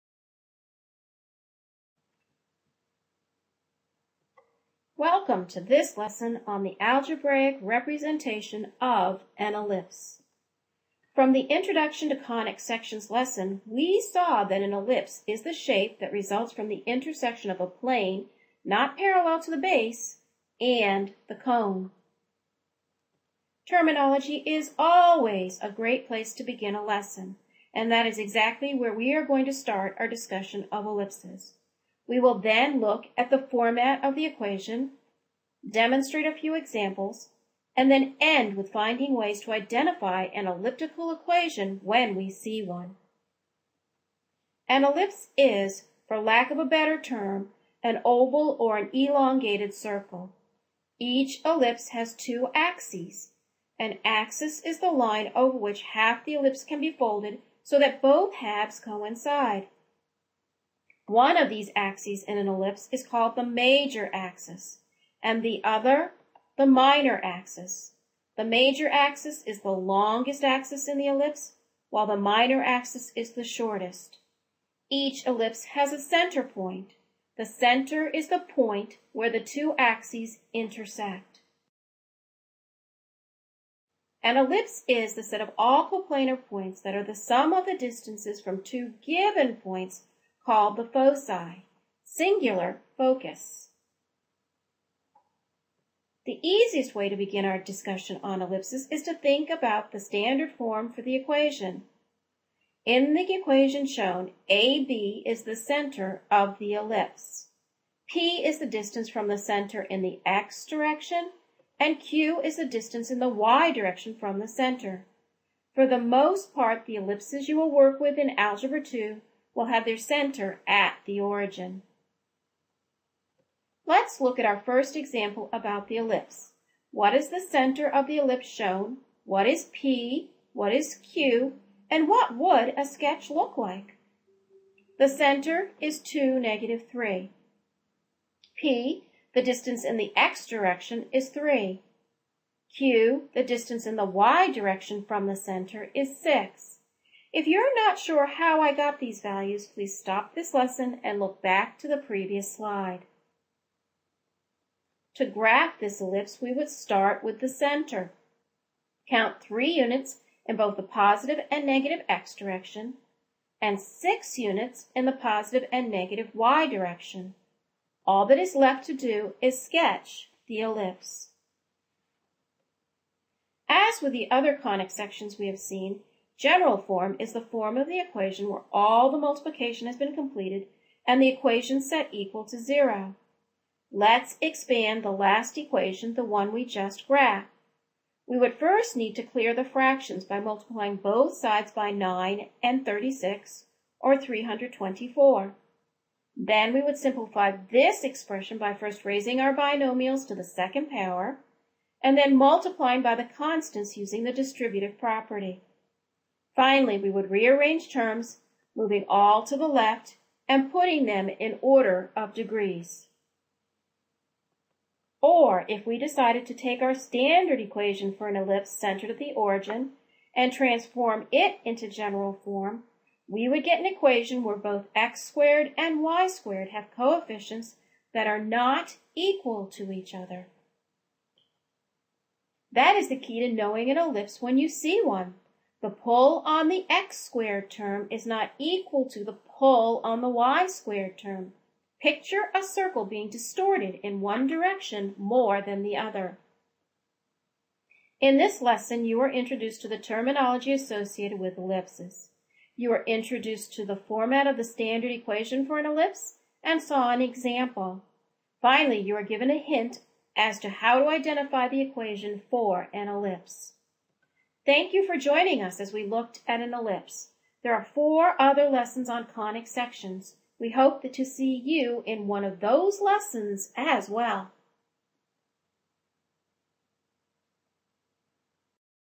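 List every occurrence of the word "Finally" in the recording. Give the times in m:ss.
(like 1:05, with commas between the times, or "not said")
3:26, 4:18.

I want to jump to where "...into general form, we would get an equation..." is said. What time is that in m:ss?
3:41.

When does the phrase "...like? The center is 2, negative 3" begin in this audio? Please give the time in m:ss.
2:13.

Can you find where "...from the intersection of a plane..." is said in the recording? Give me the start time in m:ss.
0:16.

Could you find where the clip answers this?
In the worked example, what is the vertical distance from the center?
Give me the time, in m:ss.
2:26.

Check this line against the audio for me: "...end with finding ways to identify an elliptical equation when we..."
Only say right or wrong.
right.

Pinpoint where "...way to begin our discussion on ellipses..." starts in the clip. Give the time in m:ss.
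1:36.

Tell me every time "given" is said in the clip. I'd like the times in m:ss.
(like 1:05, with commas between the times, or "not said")
1:29, 4:19.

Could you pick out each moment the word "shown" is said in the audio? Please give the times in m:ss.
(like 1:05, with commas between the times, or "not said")
1:43, 2:08.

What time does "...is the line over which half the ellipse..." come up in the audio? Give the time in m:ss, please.
0:54.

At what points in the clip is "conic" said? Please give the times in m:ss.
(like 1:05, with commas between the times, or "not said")
0:12, 2:54, 4:29.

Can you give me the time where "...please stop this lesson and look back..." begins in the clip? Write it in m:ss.
2:29.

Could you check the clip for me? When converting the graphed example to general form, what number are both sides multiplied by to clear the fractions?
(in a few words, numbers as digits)
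324.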